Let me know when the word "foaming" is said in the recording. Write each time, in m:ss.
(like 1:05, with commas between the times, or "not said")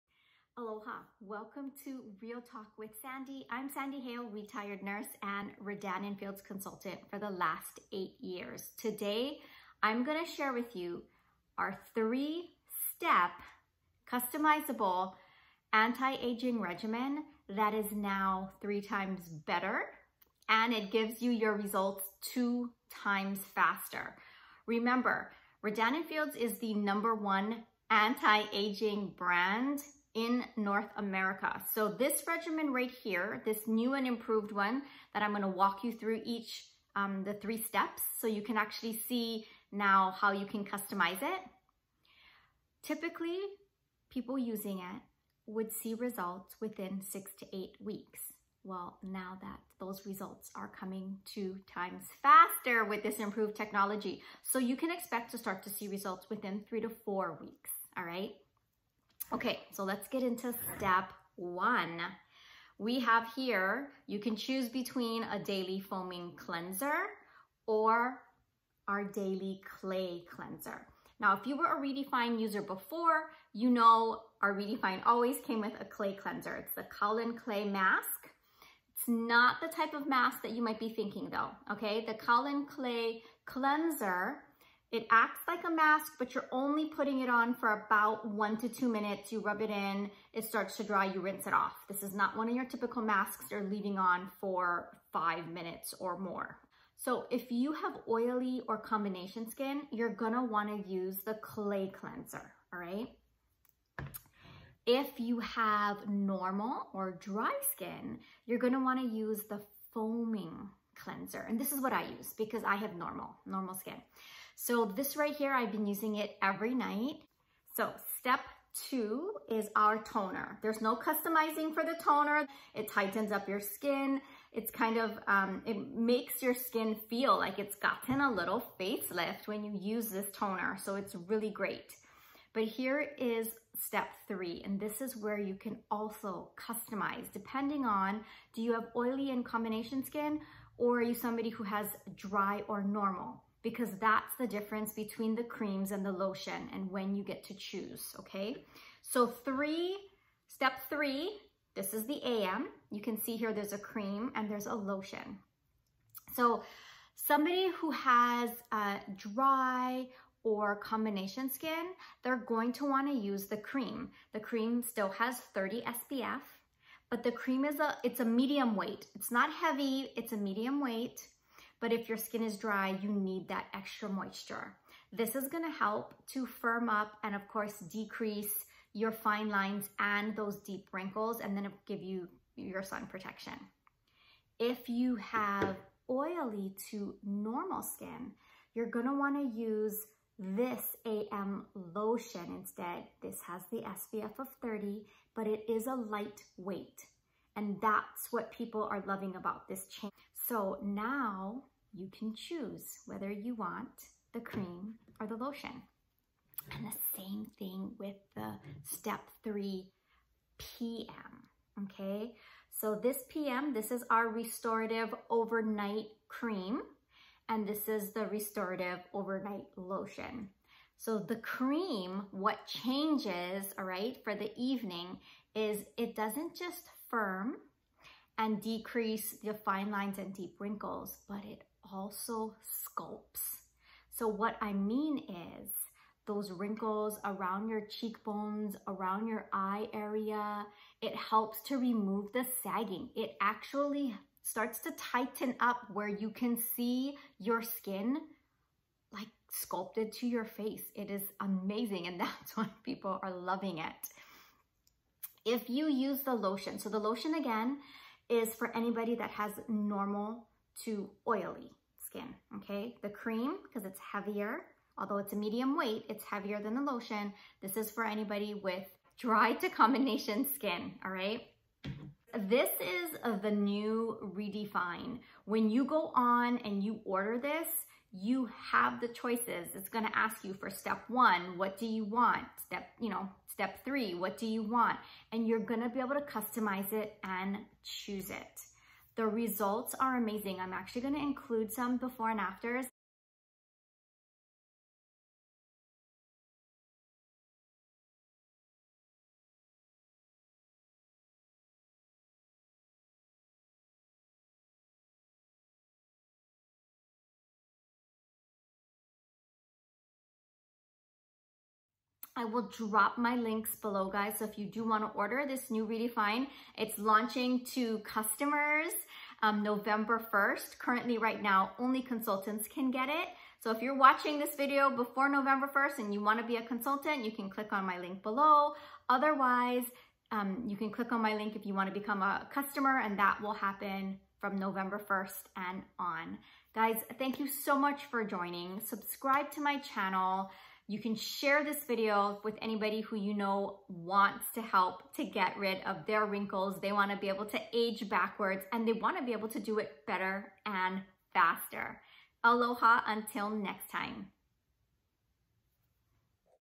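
1:05, 1:49.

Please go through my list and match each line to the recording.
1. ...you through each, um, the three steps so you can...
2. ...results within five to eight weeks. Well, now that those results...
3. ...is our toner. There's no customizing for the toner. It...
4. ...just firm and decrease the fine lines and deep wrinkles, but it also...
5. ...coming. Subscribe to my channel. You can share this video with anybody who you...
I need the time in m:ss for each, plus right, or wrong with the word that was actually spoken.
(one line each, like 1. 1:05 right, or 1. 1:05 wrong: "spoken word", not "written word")
1. 0:35 right
2. 0:45 wrong: "six", not "five"
3. 1:59 right
4. 3:46 right
5. 5:38 wrong: "joining", not "coming".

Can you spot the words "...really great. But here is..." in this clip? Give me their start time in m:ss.
2:11.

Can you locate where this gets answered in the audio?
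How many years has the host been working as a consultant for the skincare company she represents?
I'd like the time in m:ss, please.
0:07.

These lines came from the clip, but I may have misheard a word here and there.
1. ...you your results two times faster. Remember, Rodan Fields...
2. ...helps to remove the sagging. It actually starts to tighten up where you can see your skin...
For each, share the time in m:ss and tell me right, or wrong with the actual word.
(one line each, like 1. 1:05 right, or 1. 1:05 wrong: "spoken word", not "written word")
1. 0:21 right
2. 4:01 right.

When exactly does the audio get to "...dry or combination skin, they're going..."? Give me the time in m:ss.
2:39.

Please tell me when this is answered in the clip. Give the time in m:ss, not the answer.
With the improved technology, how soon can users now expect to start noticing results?
0:56.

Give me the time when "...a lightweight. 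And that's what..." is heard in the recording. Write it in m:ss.
3:15.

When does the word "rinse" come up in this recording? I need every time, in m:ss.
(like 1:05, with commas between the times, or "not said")
1:31.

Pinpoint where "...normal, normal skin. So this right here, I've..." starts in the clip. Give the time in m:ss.
1:52.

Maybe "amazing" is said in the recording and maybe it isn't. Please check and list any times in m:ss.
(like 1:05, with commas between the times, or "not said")
4:11, 4:50.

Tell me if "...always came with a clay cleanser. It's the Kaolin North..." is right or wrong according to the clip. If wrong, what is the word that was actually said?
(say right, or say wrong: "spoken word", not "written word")
wrong: "Clay", not "North".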